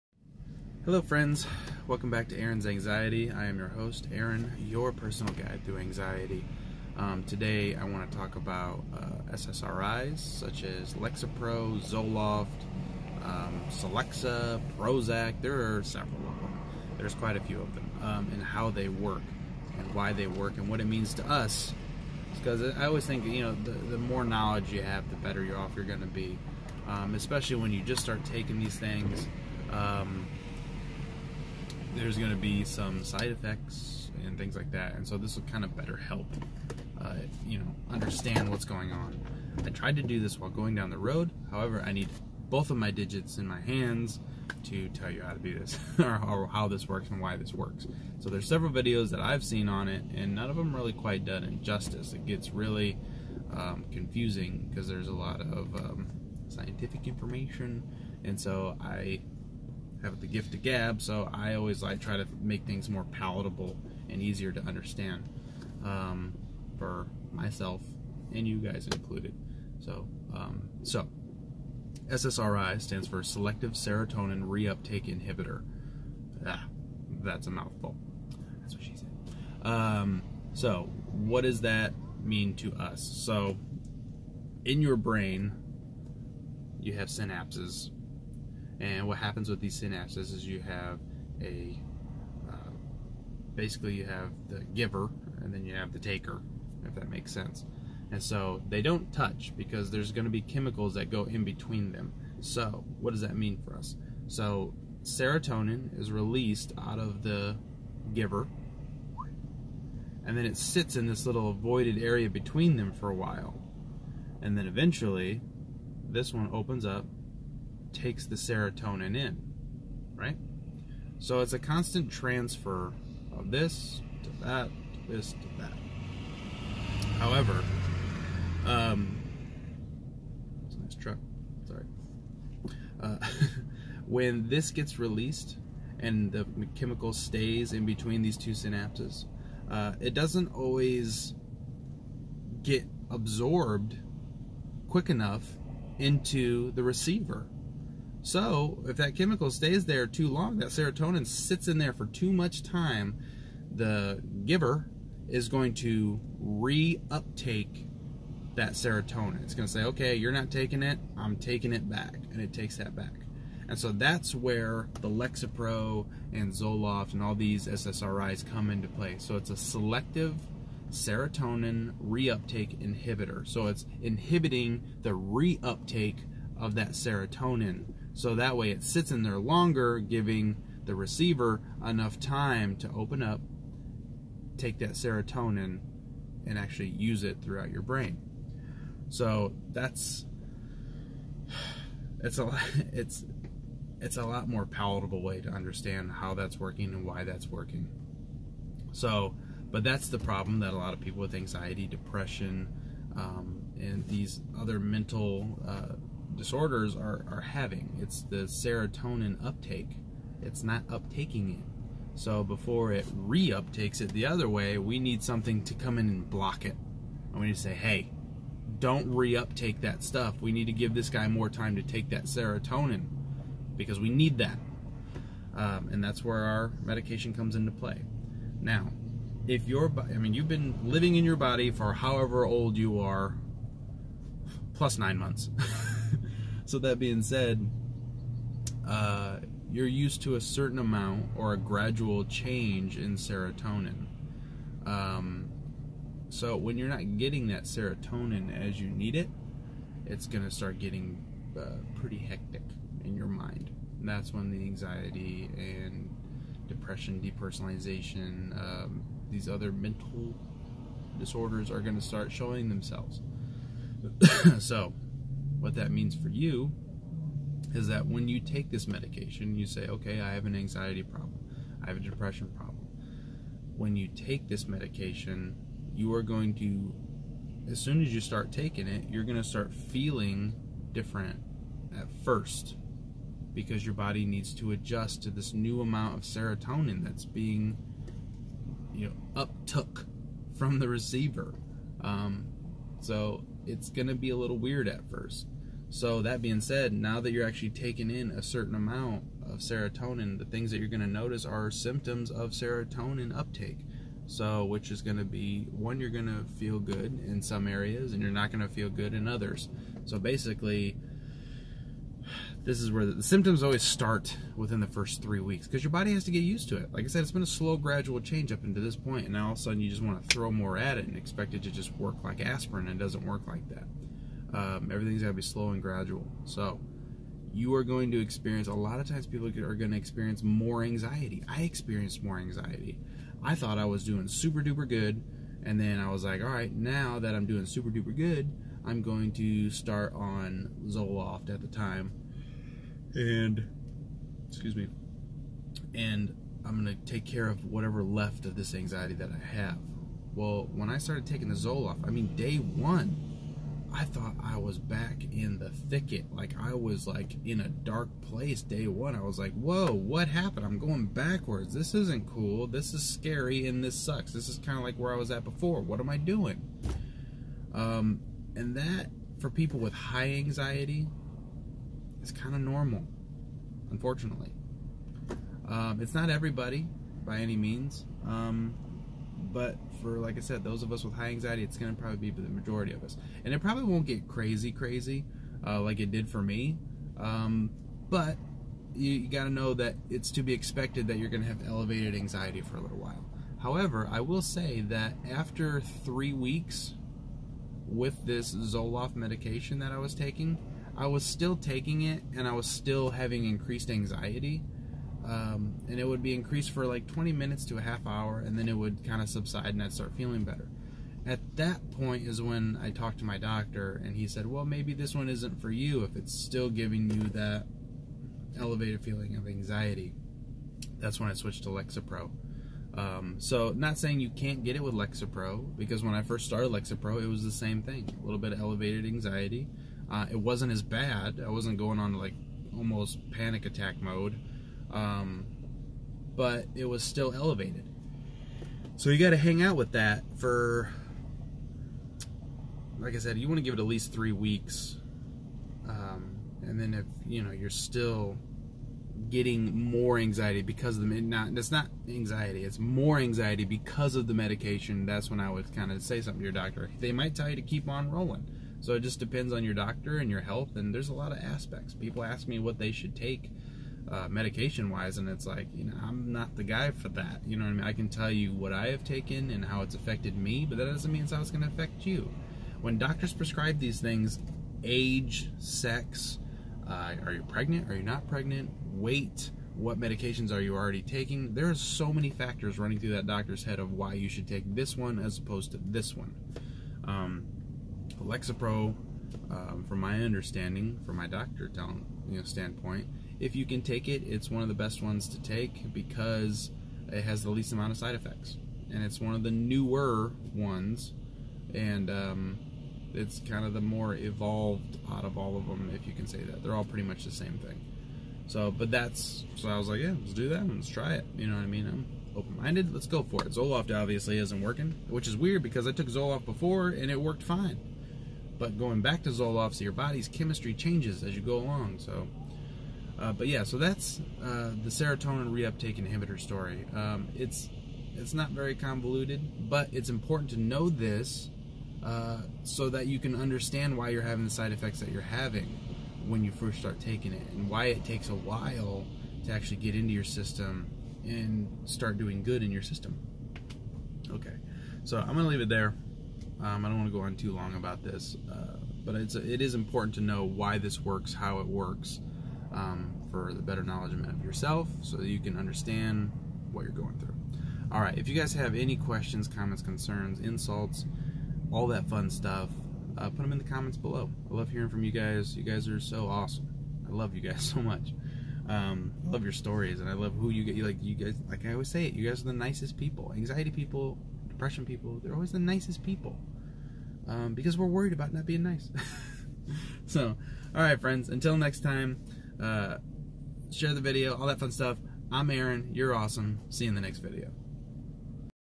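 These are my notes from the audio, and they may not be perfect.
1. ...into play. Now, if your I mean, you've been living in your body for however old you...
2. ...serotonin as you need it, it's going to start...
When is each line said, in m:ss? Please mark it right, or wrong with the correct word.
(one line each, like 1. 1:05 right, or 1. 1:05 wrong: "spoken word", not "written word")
1. 3:47 right
2. 4:07 right.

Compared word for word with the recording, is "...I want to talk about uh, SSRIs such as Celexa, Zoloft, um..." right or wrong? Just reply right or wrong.
wrong.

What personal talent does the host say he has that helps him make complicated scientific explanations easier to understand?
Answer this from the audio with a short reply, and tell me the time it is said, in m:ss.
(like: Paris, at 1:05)
the gift of gab, at 1:00.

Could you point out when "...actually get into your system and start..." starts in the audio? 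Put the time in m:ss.
8:59.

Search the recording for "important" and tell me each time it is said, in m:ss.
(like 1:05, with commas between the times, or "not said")
8:50, 9:09.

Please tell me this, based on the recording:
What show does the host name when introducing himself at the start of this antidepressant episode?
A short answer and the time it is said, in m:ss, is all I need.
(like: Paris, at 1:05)
Aaron's Anxiety, at 0:02.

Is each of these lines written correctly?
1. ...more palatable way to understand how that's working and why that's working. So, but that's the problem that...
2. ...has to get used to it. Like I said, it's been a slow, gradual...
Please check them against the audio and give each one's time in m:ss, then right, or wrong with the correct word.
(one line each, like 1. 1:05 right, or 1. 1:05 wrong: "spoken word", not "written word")
1. 3:14 right
2. 5:16 right.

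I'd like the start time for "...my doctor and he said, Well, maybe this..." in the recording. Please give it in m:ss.
6:53.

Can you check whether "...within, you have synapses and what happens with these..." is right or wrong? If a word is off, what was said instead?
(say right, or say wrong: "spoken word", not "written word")
wrong: "brain", not "within".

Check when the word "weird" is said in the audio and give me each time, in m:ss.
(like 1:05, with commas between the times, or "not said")
4:54, 8:35.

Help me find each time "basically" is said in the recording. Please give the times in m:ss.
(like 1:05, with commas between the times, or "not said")
1:33, 5:10.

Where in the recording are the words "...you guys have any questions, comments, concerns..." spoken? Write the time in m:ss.
9:18.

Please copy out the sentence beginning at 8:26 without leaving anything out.
They're all pretty much the same thing.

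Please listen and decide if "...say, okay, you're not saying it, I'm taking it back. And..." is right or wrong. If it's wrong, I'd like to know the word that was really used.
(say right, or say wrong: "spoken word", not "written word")
wrong: "taking", not "saying".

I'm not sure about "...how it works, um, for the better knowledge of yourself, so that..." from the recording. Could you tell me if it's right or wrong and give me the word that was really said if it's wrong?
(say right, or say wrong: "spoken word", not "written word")
right.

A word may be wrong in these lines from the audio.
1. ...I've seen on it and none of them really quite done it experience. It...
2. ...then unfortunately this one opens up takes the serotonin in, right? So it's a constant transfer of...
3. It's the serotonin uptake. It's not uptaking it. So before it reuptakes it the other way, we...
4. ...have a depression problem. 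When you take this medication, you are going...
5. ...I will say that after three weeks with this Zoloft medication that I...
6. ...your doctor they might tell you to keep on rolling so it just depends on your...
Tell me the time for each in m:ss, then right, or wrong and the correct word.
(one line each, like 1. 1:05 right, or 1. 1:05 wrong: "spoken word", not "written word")
1. 0:49 wrong: "justice", not "experience"
2. 1:54 wrong: "eventually", not "unfortunately"
3. 3:28 right
4. 4:31 right
5. 6:34 right
6. 7:36 right.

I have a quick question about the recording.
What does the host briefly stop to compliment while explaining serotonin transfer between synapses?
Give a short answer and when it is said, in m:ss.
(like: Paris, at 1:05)
a nice truck, at 2:10.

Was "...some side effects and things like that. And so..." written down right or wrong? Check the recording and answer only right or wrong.
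right.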